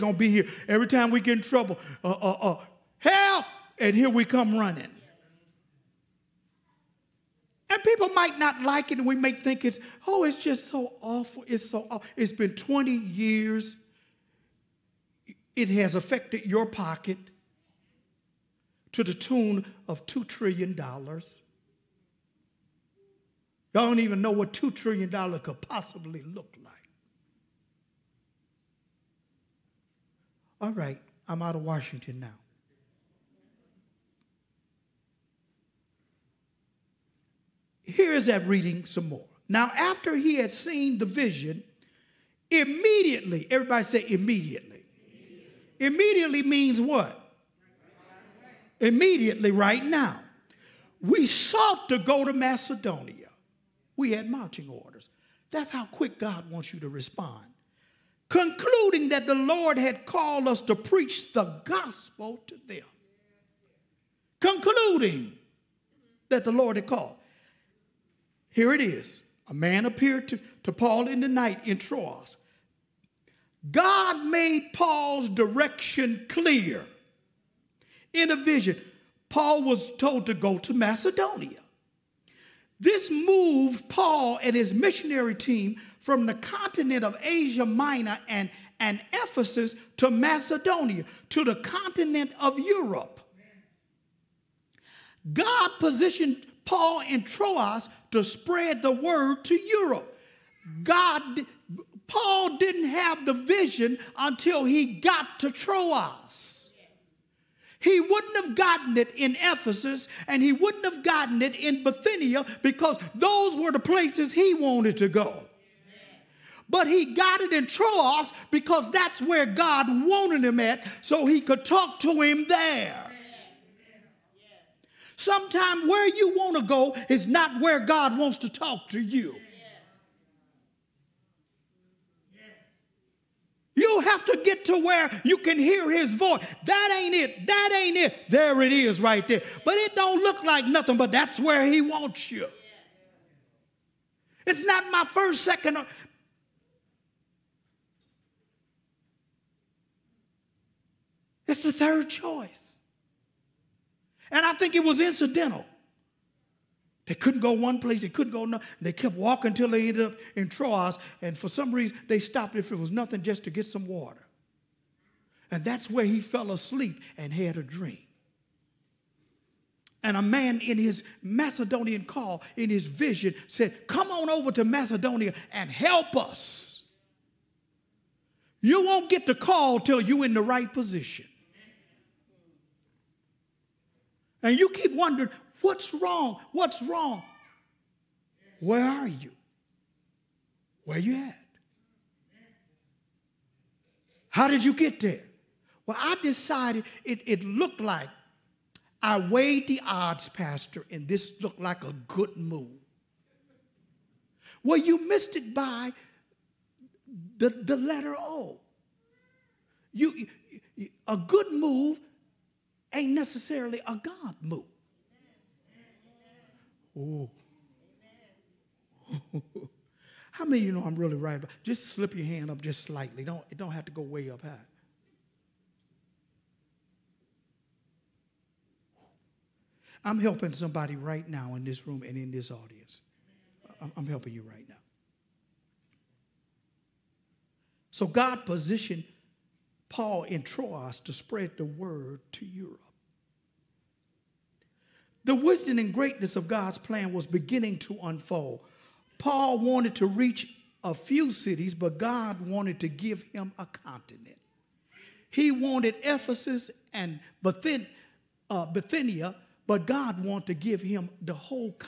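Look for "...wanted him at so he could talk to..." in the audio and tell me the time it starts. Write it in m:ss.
1:59.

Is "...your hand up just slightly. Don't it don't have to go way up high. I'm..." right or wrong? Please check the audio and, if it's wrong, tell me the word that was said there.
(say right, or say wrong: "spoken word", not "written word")
right.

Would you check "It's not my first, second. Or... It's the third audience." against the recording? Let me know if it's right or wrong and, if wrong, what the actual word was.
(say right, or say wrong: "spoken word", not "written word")
wrong: "choice", not "audience".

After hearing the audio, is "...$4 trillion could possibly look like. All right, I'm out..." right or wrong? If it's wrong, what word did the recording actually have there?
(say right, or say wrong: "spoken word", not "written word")
wrong: "2", not "4".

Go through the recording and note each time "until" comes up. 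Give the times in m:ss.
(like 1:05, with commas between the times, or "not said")
1:44, 2:39.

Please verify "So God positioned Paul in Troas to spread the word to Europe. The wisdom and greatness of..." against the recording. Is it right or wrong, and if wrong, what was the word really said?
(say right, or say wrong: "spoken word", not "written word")
right.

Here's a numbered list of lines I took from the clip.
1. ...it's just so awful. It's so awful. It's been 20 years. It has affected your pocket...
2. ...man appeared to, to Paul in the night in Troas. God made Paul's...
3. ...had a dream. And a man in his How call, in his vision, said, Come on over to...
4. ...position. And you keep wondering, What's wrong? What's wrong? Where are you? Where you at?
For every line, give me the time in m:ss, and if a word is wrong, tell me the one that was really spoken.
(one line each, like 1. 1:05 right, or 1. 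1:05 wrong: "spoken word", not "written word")
1. 0:10 right
2. 1:09 right
3. 2:47 wrong: "Macedonian", not "How"
4. 3:00 right.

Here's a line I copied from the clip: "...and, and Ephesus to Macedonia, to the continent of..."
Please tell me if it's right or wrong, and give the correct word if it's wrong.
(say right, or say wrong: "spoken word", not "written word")
right.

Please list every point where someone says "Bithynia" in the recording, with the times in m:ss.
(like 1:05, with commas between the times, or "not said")
1:51, 4:18.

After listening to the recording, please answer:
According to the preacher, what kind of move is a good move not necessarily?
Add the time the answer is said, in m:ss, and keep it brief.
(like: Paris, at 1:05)
A God move, at 3:34.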